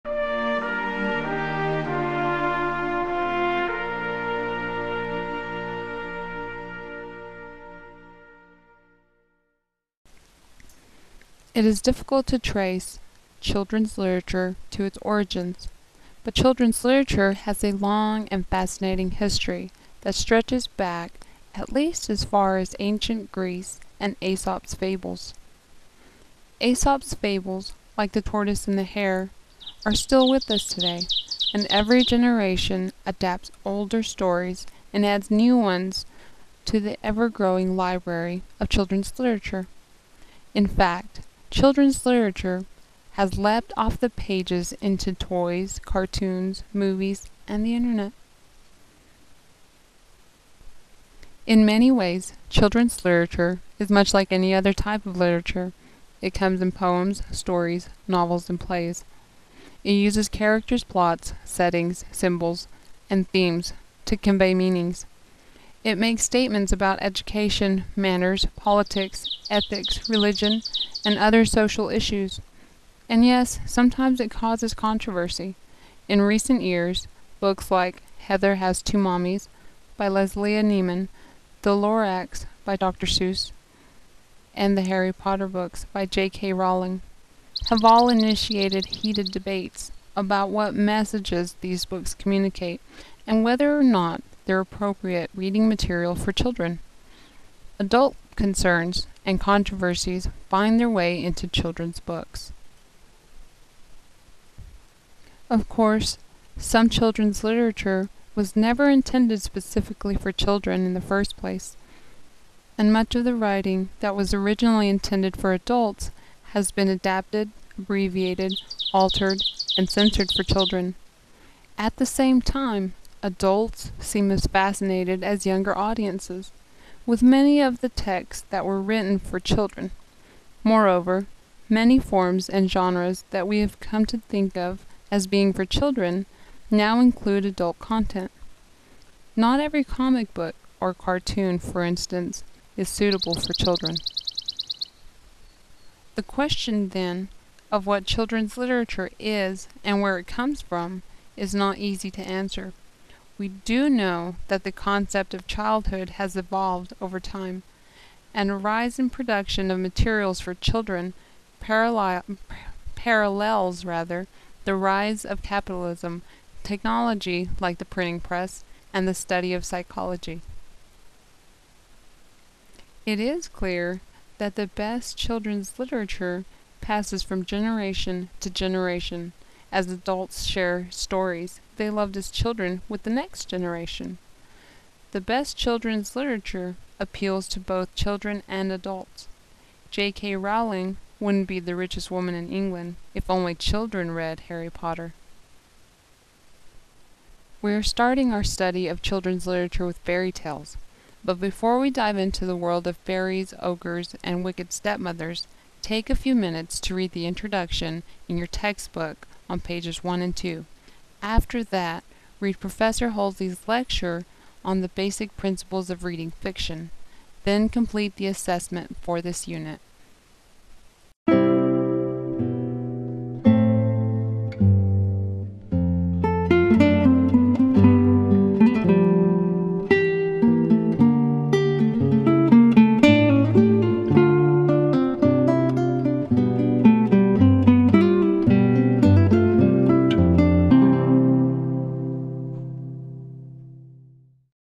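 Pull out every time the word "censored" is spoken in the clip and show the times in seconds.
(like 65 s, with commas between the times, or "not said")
119 s.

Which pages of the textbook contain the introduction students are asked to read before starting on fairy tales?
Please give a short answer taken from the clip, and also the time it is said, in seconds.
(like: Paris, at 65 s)
pages 1 and 2, at 209 s.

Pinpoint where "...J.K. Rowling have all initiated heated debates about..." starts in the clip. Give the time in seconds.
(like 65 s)
86 s.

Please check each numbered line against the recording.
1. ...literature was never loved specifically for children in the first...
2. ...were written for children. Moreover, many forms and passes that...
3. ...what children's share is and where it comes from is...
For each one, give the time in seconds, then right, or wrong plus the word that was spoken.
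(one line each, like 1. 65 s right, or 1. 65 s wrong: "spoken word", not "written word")
1. 107 s wrong: "intended", not "loved"
2. 128 s wrong: "genres", not "passes"
3. 147 s wrong: "literature", not "share".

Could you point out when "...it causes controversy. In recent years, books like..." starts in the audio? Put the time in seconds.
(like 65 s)
74 s.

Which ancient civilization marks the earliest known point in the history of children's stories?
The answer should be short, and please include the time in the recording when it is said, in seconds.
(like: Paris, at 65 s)
ancient Greece, at 22 s.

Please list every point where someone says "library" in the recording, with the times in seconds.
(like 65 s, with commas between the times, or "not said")
37 s.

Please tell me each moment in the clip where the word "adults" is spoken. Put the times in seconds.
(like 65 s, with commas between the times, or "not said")
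97 s, 115 s, 123 s, 137 s, 179 s, 188 s.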